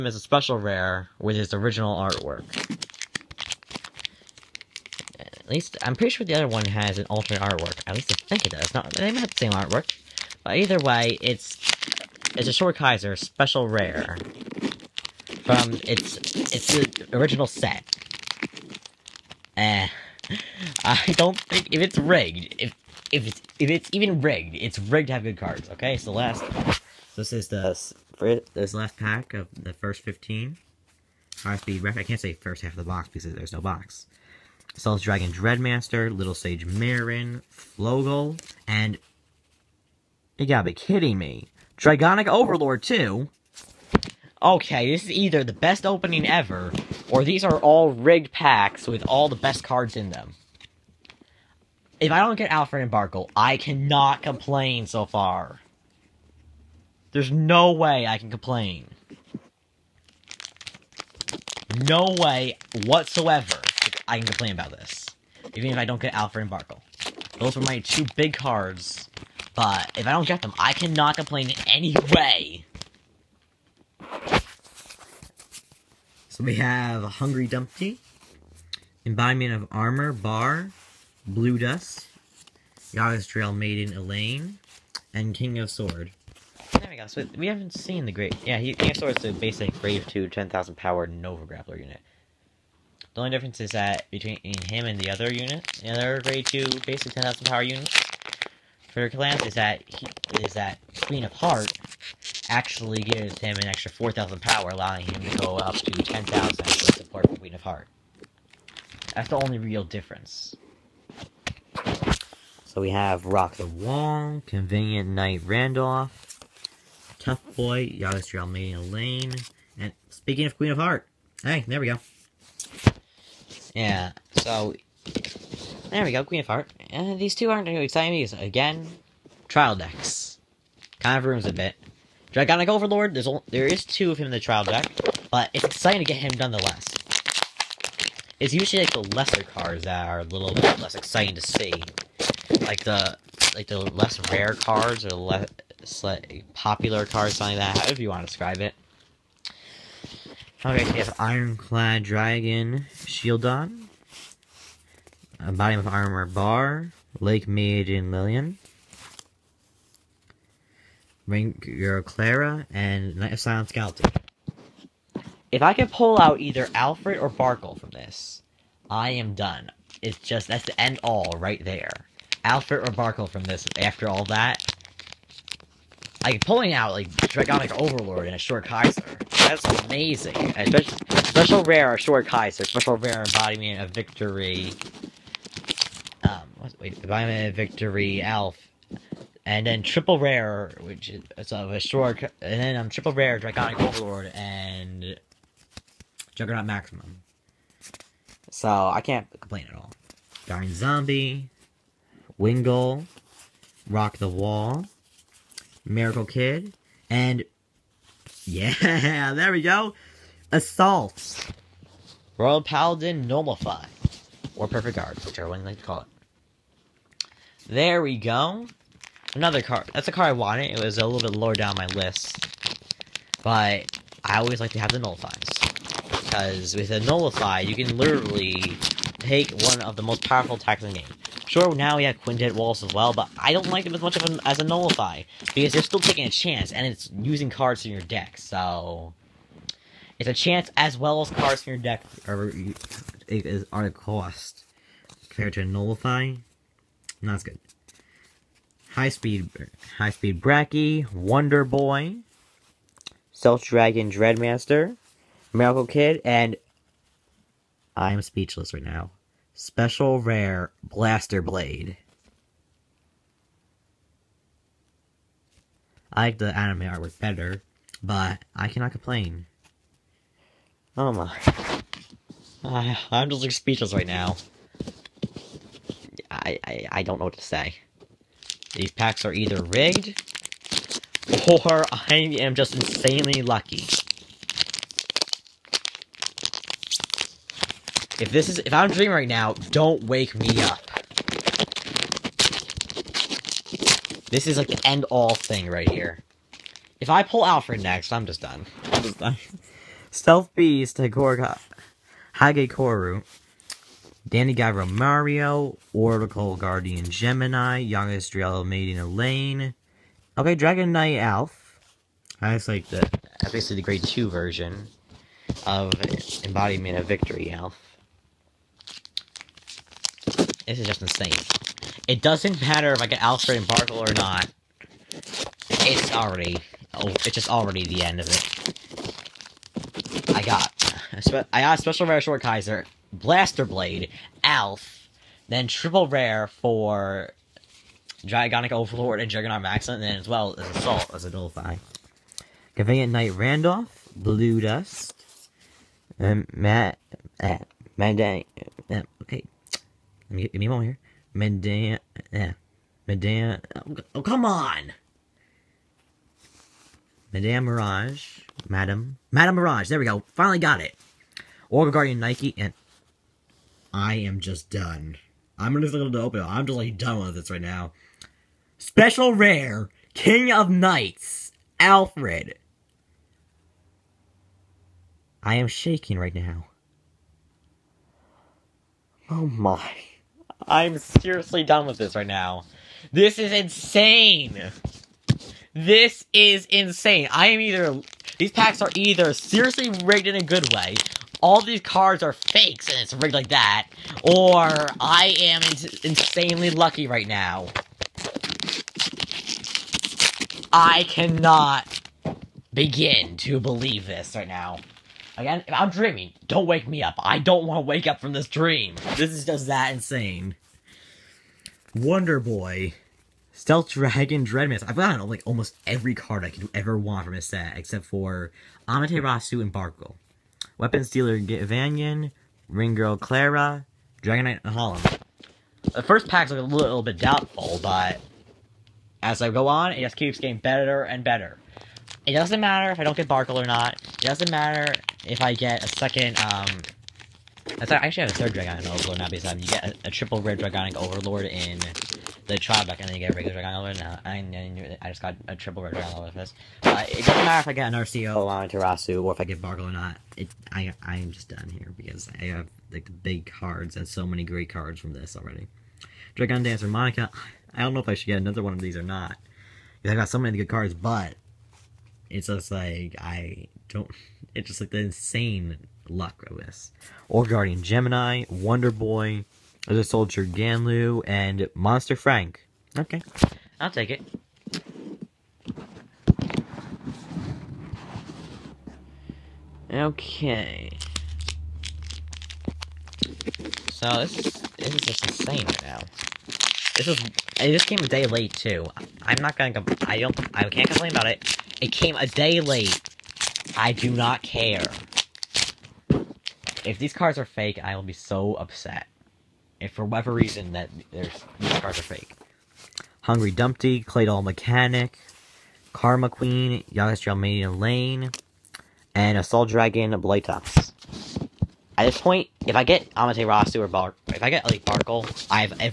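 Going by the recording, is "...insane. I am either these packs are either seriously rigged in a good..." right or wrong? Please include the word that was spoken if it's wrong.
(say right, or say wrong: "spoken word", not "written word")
right.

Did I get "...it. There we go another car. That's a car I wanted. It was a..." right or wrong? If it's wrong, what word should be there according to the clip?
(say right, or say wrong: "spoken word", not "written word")
right.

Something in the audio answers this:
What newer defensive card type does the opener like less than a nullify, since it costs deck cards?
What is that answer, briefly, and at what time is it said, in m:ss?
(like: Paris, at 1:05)
Quintet Walls, at 3:52.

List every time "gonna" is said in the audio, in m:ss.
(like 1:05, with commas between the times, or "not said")
6:05, 8:09.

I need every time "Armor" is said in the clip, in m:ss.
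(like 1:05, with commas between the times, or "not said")
1:19, 2:35.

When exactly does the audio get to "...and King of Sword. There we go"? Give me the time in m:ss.
1:25.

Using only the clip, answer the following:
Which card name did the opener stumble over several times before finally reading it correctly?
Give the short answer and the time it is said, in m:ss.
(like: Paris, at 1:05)
Madame Mirage, at 5:57.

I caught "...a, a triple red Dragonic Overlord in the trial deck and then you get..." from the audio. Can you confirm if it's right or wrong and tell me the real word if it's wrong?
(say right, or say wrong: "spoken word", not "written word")
right.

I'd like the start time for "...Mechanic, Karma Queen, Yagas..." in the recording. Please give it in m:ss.
8:24.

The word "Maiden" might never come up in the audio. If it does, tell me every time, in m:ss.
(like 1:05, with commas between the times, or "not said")
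1:23, 5:08.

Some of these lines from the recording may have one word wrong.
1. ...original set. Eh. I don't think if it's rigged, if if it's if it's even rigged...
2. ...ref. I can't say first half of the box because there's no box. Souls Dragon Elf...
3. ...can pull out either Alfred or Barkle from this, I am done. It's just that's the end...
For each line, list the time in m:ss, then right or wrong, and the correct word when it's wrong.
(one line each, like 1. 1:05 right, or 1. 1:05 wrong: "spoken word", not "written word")
1. 0:17 right
2. 0:31 wrong: "Dreadmaster", not "Elf"
3. 2:45 right.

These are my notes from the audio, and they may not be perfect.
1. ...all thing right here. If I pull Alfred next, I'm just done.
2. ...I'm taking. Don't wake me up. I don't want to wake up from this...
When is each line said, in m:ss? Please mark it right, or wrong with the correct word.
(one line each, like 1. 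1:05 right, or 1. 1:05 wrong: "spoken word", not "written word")
1. 4:55 right
2. 6:45 wrong: "dreaming", not "taking".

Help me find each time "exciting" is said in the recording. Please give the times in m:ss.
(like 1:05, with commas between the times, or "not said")
2:07, 2:15, 2:20.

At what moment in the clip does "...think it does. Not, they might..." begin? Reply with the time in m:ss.
0:08.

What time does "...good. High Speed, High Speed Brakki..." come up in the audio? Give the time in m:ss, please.
4:07.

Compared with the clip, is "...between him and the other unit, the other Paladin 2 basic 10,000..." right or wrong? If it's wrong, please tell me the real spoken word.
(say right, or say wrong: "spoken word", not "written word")
wrong: "Grade", not "Paladin".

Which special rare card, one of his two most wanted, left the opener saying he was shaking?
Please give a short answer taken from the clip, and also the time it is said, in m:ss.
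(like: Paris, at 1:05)
King of Knights Alfred, at 6:10.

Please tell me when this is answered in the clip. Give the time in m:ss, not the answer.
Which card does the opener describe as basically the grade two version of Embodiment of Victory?
5:10.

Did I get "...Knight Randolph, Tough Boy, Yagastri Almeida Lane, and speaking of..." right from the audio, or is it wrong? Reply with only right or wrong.
right.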